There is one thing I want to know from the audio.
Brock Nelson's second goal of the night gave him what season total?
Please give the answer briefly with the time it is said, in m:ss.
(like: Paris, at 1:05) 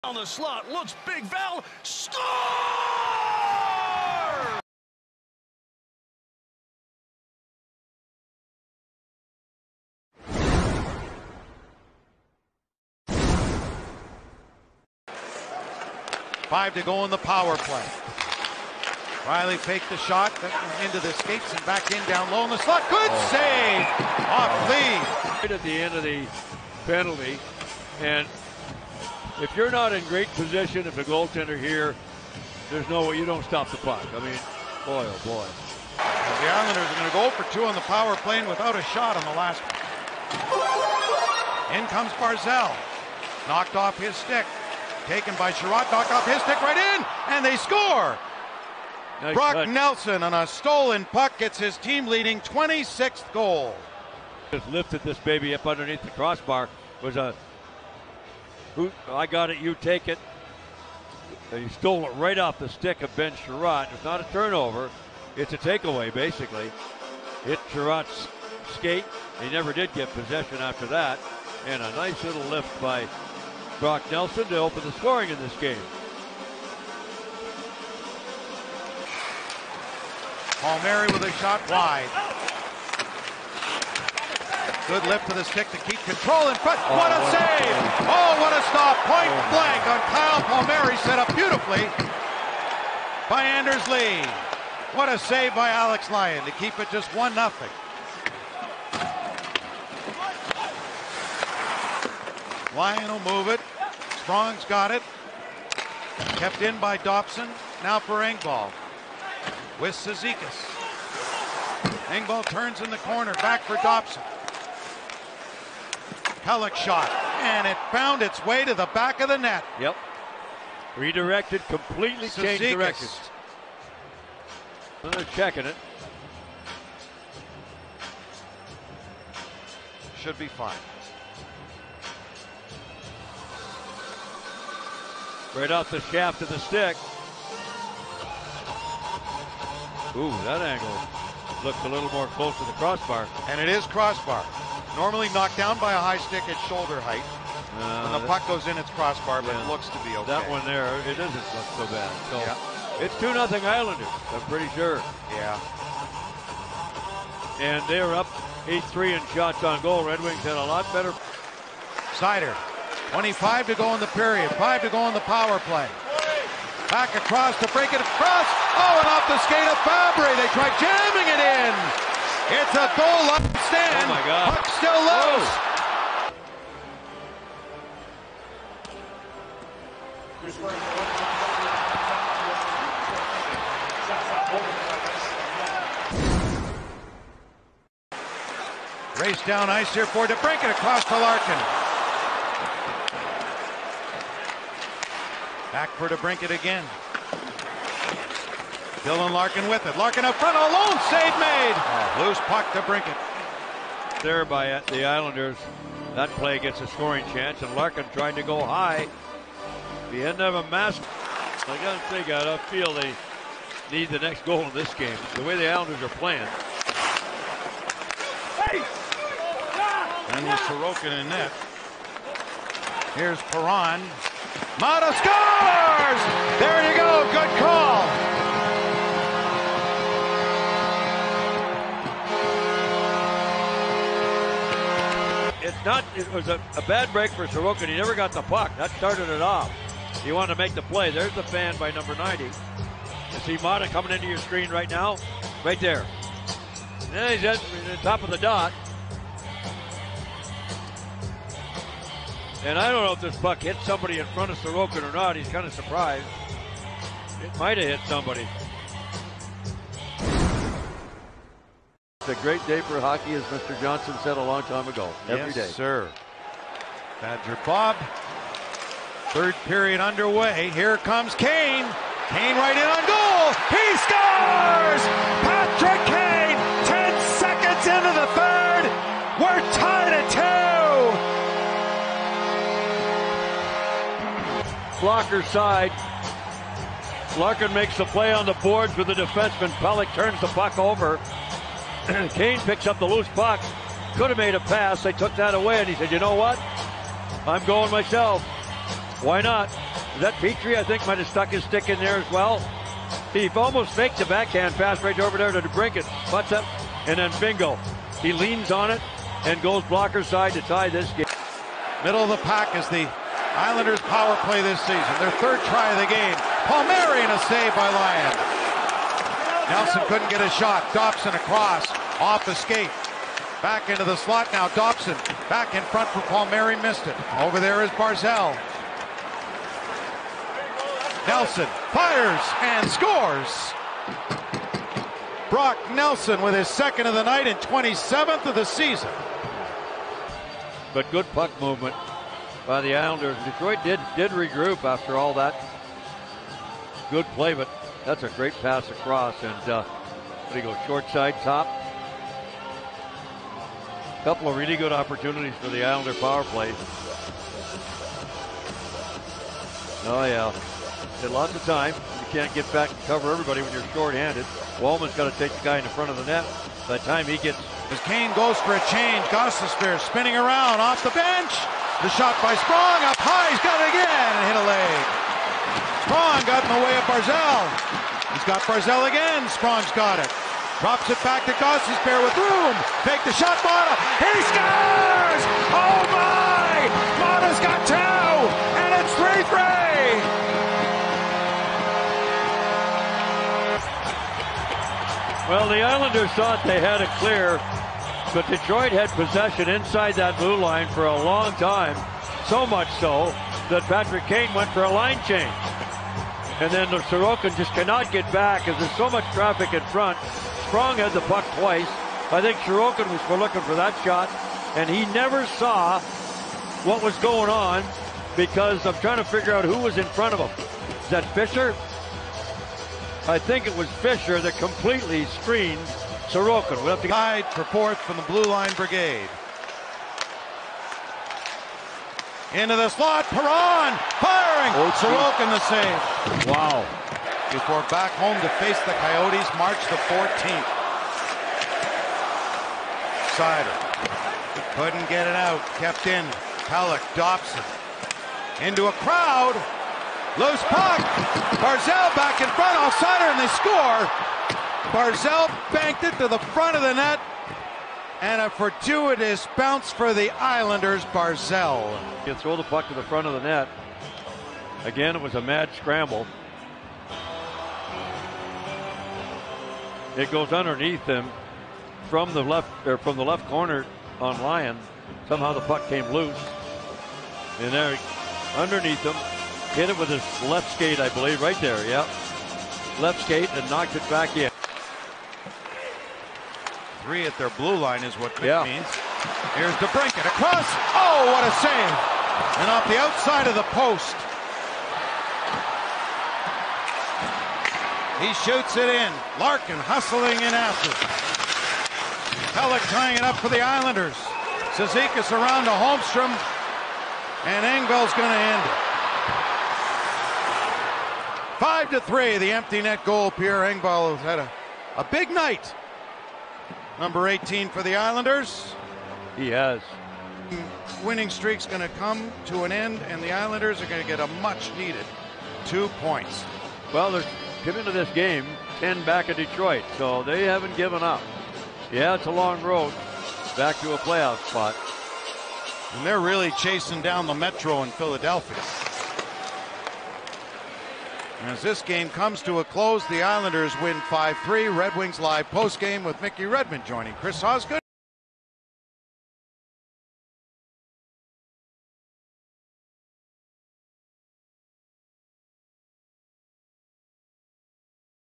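27, at 5:37.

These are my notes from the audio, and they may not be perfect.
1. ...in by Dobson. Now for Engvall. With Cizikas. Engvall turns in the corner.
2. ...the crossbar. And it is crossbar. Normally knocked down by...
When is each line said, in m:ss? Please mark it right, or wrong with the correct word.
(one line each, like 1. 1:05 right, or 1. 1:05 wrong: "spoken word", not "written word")
1. 1:46 right
2. 2:22 right.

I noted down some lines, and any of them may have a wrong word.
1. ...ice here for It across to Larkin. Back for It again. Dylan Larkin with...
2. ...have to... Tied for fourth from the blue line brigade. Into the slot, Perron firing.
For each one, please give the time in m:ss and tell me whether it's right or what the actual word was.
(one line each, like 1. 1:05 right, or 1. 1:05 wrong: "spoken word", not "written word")
1. 3:09 right
2. 7:06 right.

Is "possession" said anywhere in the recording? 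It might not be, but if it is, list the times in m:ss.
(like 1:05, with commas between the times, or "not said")
1:10, 6:39.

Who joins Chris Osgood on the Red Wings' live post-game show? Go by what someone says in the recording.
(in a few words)
Mickey Redmond.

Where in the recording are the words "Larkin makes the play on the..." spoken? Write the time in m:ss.
4:47.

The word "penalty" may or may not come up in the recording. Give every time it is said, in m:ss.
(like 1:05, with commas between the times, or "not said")
0:26.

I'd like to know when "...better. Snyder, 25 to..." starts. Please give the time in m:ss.
2:40.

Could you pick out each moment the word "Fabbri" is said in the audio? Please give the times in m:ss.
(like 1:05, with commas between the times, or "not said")
2:49.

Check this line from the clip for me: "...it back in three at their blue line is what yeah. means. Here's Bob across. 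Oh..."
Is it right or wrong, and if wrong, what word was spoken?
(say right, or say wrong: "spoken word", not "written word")
wrong: "DeBrincat", not "Bob".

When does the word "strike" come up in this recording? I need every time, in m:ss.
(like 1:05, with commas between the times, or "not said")
not said.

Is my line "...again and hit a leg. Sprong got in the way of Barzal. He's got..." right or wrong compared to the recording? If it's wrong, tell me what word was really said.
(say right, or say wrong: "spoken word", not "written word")
right.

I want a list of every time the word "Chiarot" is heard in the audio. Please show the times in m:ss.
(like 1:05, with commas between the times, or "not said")
0:45, 1:03, 1:07.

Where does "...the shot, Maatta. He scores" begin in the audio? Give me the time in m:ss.
6:23.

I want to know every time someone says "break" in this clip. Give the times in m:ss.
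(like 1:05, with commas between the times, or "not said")
2:47, 3:57.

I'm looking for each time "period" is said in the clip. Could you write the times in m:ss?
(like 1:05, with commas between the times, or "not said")
2:44, 4:29.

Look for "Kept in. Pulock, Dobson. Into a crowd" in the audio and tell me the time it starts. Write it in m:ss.
7:25.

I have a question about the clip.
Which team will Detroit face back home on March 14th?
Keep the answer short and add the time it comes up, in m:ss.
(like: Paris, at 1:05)
Coyotes, at 7:18.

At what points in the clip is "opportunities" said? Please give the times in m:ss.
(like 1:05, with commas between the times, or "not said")
5:54.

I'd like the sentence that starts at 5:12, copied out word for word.
Middle of the pack is the Islanders' power play this season.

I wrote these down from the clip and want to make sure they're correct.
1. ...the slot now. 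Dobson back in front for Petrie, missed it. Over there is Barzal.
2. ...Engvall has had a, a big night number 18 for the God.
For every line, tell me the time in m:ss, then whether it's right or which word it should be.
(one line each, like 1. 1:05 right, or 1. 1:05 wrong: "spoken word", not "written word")
1. 5:24 wrong: "Palmieri", not "Petrie"
2. 8:33 wrong: "Islanders", not "God".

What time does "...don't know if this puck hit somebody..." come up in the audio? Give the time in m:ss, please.
4:12.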